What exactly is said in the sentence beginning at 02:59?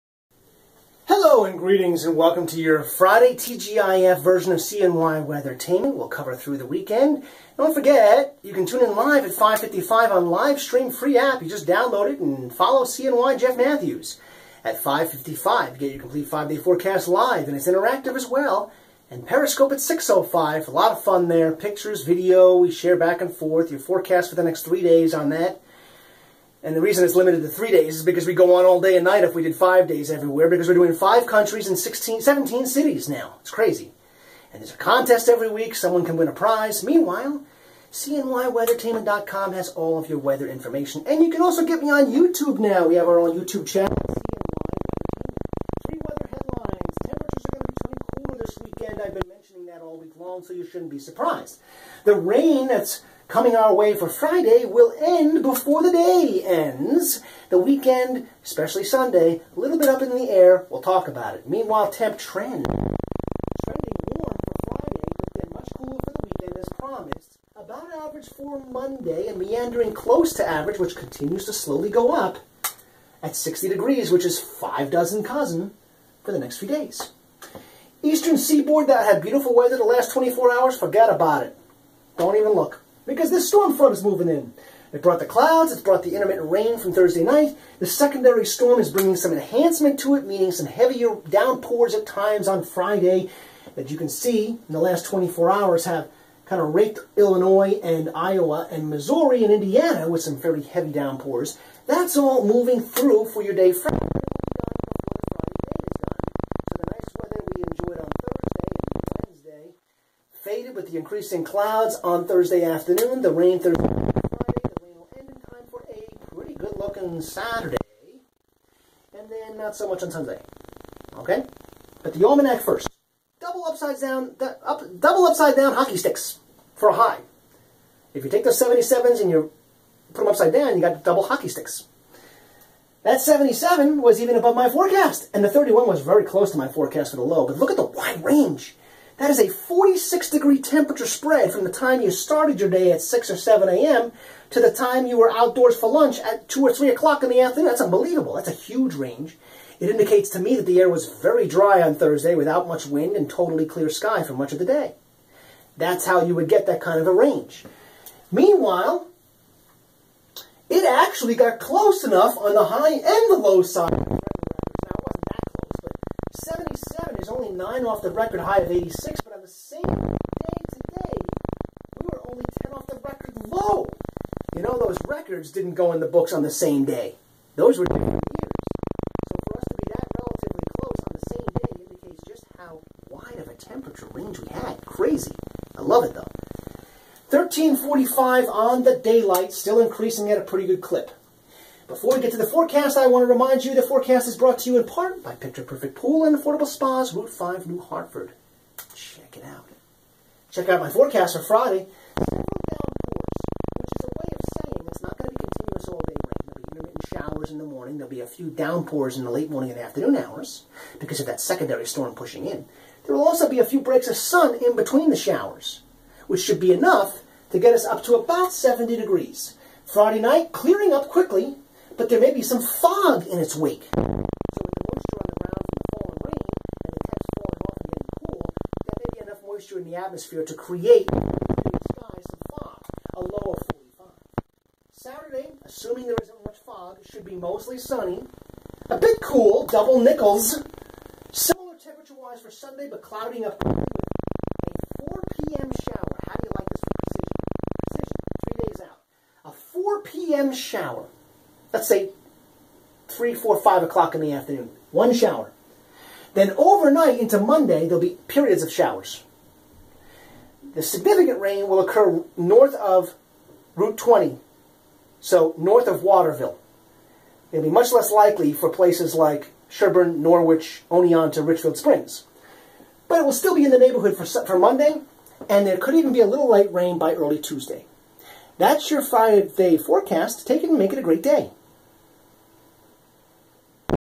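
So for us to be that relatively close on the same day indicates just how wide of a temperature range we had.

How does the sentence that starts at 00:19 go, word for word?
And Periscope at 6.05, a lot of fun there.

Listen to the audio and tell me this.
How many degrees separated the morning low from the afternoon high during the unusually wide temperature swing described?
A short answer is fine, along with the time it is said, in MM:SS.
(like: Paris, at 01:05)
46, at 02:19.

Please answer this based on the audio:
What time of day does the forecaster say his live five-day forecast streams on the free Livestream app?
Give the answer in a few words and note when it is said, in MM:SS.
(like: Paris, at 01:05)
5:55, at 00:14.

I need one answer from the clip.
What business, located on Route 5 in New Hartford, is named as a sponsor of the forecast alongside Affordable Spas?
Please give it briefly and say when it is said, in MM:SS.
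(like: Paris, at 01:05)
Picture Perfect Pool, at 03:15.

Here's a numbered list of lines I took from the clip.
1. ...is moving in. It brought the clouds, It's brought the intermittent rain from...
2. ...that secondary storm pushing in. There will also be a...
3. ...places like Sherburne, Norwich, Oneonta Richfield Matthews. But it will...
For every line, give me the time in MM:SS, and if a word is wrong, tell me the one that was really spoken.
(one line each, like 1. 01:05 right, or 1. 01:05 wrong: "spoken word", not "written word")
1. 01:23 right
2. 03:31 right
3. 04:28 wrong: "Springs", not "Matthews".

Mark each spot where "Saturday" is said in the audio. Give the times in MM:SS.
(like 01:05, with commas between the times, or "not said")
01:57, 03:54.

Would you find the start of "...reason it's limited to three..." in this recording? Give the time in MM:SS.
00:26.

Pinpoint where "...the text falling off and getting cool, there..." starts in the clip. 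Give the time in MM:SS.
03:46.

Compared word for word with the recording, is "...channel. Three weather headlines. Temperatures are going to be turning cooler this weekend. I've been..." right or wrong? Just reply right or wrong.
right.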